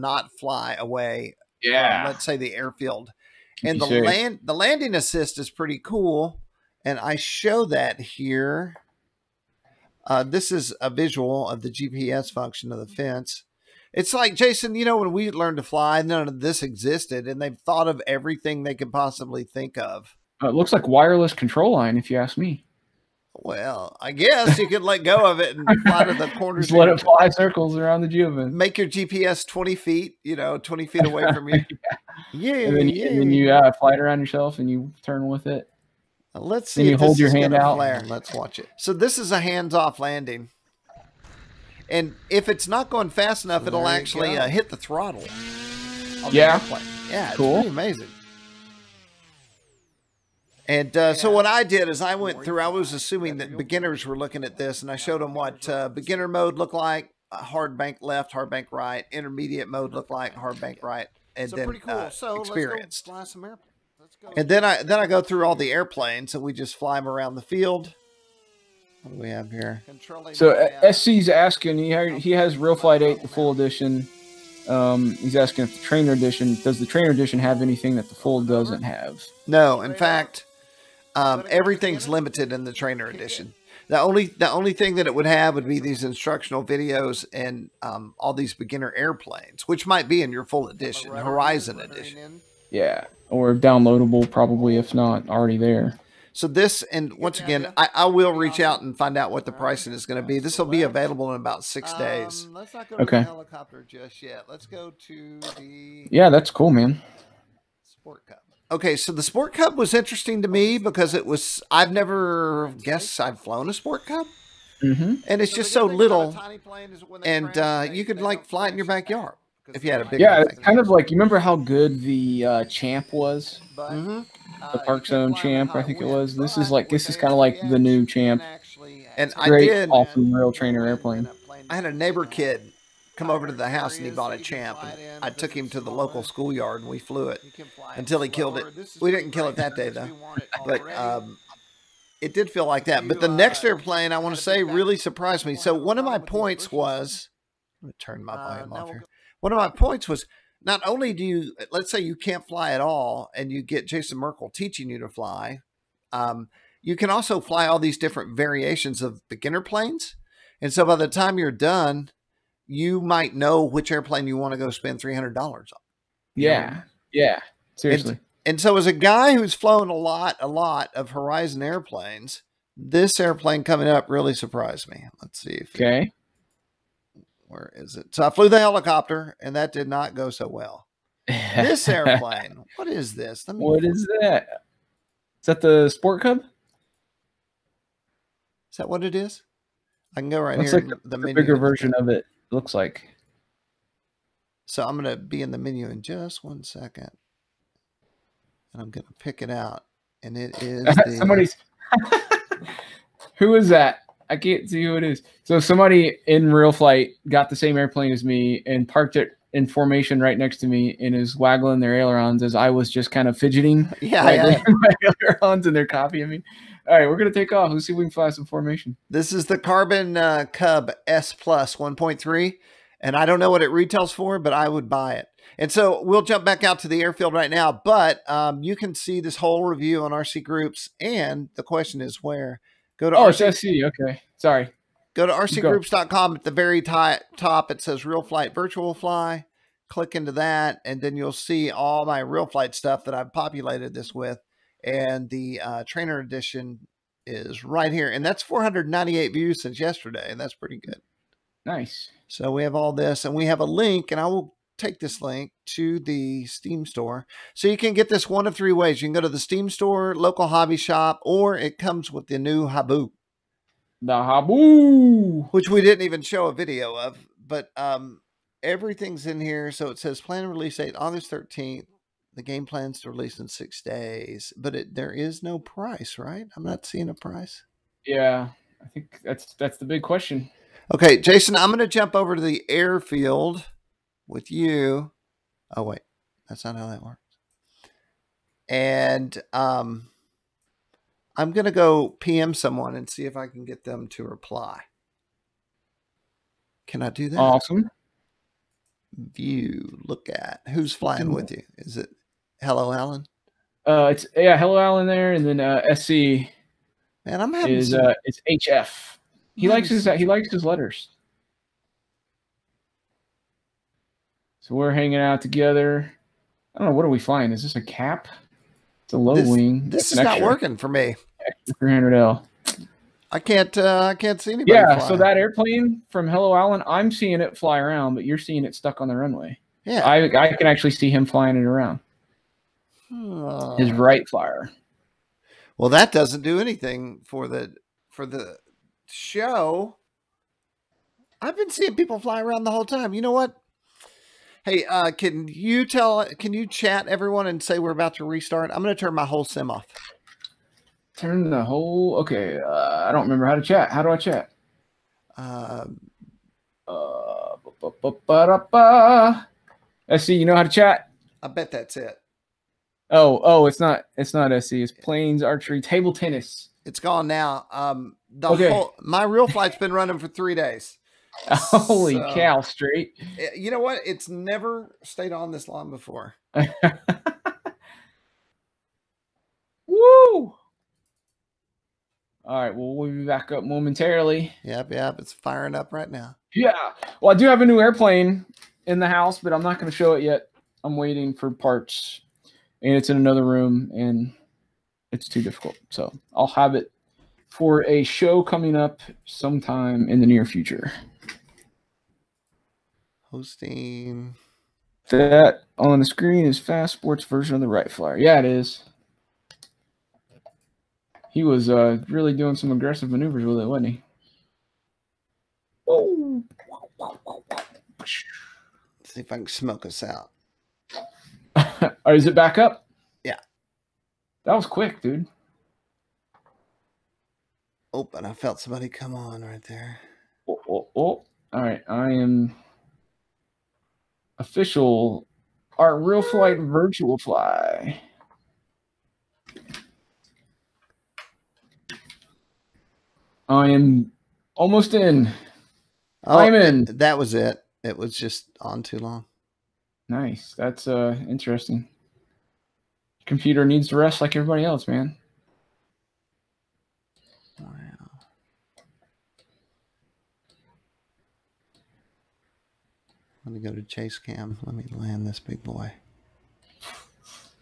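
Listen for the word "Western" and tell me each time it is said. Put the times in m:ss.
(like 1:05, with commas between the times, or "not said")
not said.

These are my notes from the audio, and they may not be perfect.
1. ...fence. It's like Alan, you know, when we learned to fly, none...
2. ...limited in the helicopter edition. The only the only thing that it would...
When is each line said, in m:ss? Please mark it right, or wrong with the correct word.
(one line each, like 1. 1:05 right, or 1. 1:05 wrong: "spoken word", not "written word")
1. 0:12 wrong: "Jason", not "Alan"
2. 1:22 wrong: "trainer", not "helicopter".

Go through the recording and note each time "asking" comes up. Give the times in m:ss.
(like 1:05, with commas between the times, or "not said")
1:11, 1:15.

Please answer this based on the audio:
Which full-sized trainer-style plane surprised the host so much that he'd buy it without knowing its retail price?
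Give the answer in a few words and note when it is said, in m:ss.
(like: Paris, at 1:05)
Carbon Cub S Plus 1.3, at 3:39.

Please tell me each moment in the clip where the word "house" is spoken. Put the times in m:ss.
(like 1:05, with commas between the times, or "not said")
2:13, 6:29.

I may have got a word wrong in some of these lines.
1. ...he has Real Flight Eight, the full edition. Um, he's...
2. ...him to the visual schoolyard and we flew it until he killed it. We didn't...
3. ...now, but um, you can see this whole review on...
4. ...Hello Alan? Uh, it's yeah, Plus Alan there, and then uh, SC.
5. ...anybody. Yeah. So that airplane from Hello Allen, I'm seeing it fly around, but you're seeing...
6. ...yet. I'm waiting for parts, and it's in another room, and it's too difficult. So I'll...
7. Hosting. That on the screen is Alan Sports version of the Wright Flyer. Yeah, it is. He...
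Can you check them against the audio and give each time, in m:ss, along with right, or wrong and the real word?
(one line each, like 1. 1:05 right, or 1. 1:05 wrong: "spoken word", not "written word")
1. 1:12 right
2. 2:15 wrong: "local", not "visual"
3. 3:47 right
4. 5:02 wrong: "Hello", not "Plus"
5. 5:24 right
6. 6:30 right
7. 6:43 wrong: "Fast", not "Alan".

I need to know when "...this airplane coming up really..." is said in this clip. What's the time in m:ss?
2:52.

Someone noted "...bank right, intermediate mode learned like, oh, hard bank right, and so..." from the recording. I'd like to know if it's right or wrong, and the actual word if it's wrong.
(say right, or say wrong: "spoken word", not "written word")
wrong: "looked", not "learned".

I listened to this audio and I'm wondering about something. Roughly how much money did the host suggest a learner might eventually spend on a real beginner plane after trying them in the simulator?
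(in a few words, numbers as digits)
$300.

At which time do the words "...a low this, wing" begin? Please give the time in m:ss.
5:19.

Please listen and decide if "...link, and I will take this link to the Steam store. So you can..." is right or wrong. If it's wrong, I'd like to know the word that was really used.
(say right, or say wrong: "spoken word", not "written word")
right.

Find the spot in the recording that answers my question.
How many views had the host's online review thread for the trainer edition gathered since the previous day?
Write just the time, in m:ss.
4:08.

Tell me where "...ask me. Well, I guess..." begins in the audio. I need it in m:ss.
0:22.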